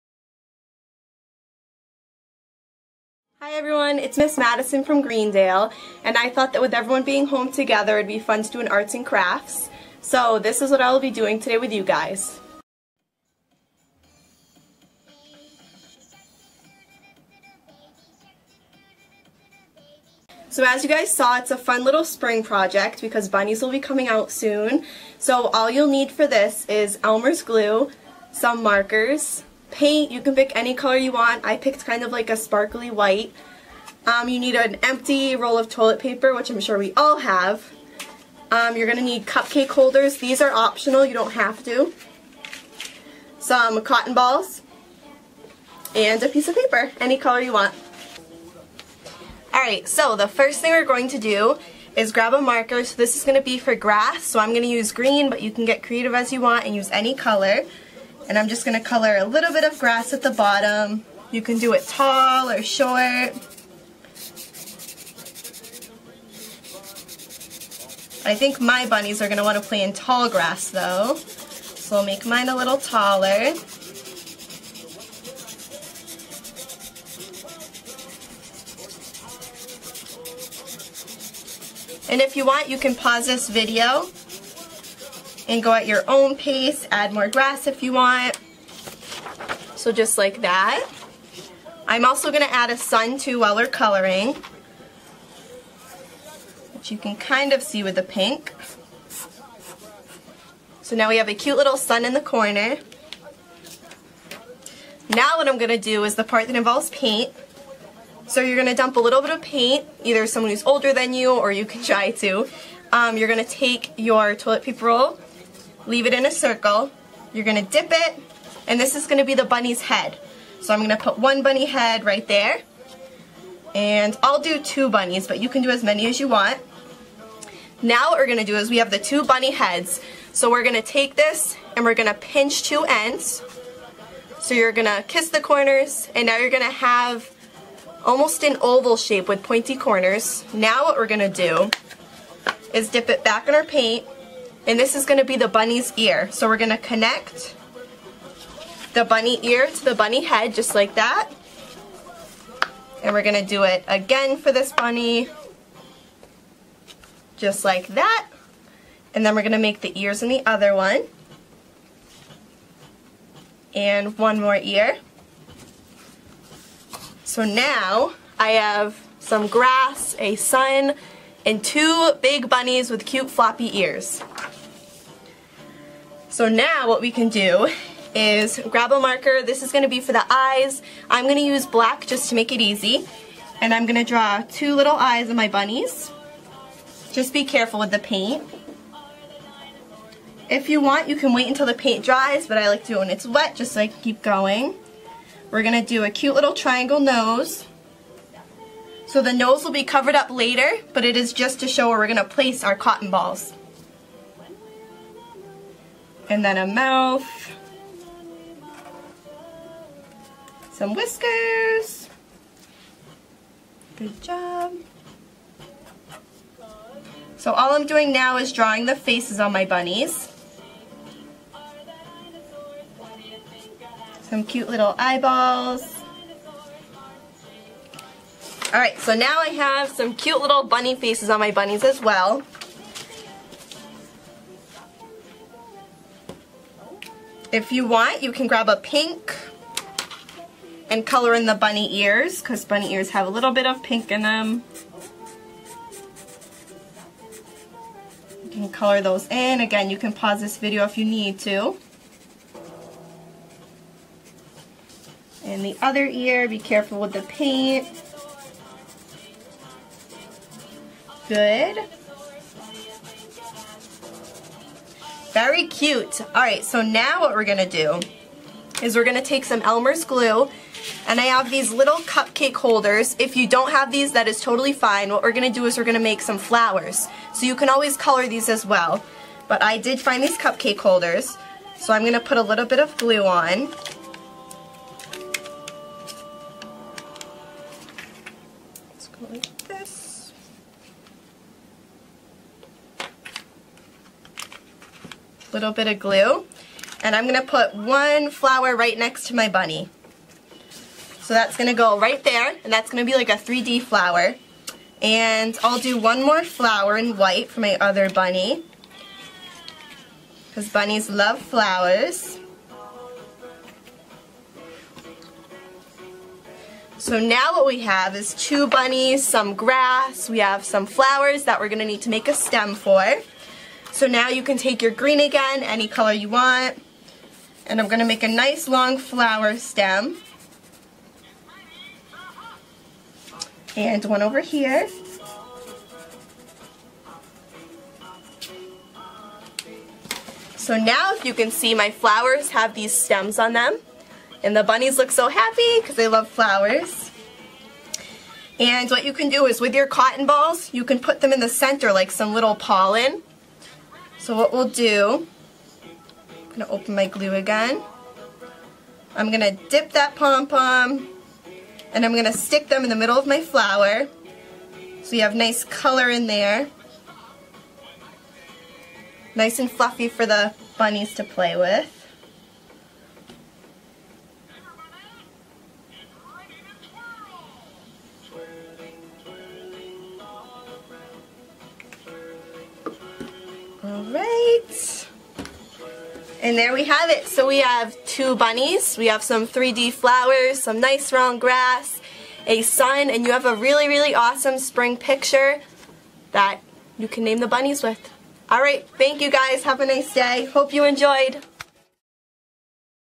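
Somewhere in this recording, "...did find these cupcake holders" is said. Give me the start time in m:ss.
4:39.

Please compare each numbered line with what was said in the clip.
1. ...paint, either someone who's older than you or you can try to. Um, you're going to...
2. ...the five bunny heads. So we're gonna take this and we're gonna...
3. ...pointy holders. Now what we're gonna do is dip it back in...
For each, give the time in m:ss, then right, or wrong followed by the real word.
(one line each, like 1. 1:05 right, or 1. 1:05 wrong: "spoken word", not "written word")
1. 1:49 right
2. 2:08 wrong: "two", not "five"
3. 2:19 wrong: "corners", not "holders".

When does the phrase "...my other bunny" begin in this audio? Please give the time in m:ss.
5:07.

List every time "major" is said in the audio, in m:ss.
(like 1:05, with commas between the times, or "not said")
not said.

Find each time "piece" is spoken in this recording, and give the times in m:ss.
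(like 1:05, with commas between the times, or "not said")
0:46.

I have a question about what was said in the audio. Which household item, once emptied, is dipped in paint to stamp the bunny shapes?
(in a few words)
roll of toilet paper.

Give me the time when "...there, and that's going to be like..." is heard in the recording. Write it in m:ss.
5:02.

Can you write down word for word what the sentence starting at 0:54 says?
So I'm going to use green, but you can get creative as you want and use any color.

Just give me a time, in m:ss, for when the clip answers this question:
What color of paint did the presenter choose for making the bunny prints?
0:32.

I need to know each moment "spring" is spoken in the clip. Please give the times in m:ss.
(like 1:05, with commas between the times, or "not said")
0:22, 6:34.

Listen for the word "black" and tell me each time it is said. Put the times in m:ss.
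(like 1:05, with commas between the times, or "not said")
3:01.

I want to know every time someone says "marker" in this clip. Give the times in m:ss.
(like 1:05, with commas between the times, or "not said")
0:28, 0:52, 2:59.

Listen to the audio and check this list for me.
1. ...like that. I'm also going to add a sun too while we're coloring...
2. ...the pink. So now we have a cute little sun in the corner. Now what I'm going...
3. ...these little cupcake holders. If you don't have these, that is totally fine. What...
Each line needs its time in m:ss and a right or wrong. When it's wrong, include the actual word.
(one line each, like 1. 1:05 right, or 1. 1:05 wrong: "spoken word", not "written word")
1. 1:30 right
2. 1:37 right
3. 4:31 right.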